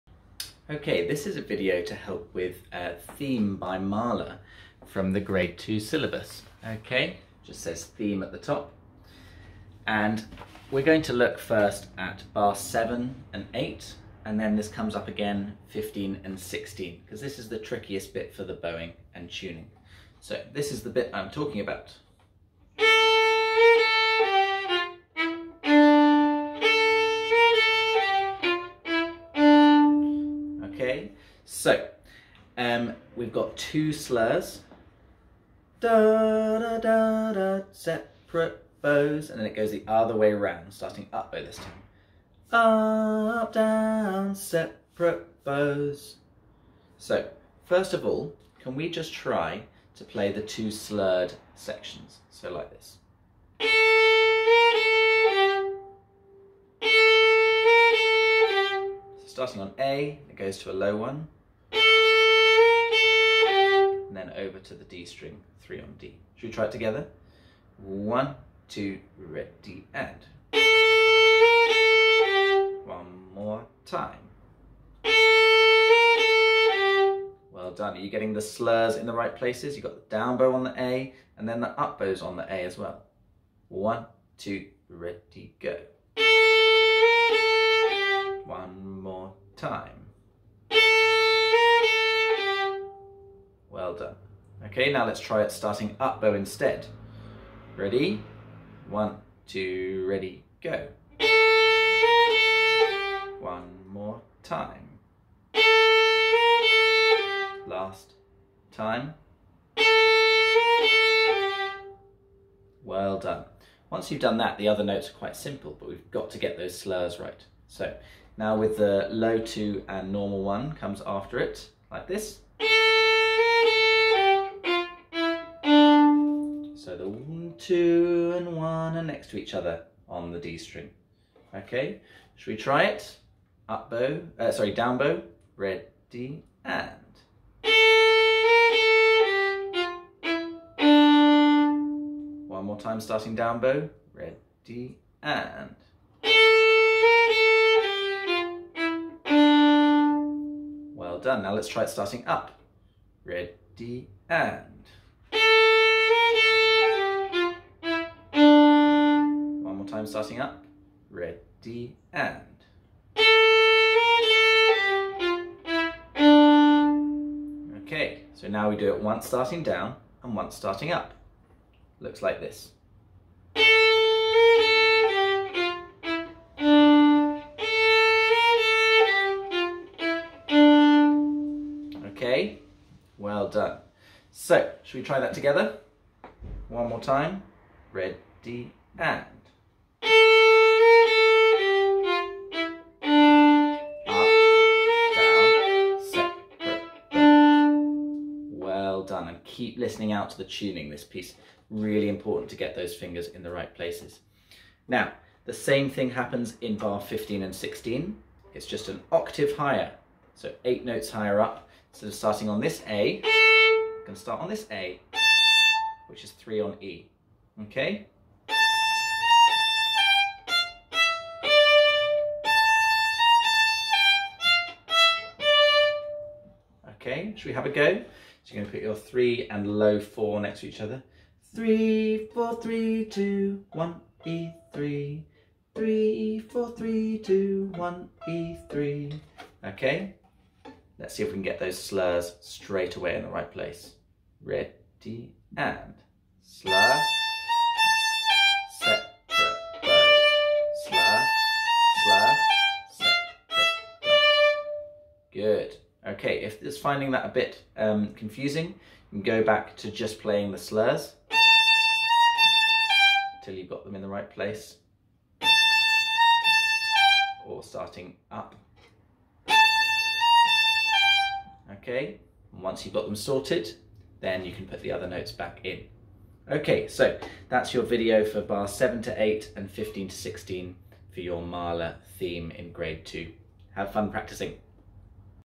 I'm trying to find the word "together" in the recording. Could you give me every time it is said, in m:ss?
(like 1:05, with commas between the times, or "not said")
1:06, 3:05.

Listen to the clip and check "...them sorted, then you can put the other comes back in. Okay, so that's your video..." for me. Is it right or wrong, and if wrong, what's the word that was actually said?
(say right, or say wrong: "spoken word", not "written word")
wrong: "notes", not "comes".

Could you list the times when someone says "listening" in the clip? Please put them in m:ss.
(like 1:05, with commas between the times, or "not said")
3:19.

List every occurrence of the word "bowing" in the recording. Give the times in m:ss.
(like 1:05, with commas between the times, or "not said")
0:18.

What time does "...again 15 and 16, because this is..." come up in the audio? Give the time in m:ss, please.
0:15.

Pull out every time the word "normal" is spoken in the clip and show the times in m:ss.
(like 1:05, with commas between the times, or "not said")
2:00.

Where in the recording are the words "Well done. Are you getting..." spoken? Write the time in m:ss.
1:17.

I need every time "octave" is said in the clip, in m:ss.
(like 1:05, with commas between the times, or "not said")
3:29.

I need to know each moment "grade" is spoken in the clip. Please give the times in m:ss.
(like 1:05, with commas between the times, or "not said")
0:05, 4:42.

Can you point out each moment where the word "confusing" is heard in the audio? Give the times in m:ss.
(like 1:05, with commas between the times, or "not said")
4:18.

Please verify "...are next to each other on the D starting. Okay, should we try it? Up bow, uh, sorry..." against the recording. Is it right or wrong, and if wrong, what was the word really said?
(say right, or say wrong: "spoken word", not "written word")
wrong: "string", not "starting".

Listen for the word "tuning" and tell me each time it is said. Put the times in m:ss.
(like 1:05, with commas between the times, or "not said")
0:19, 3:20.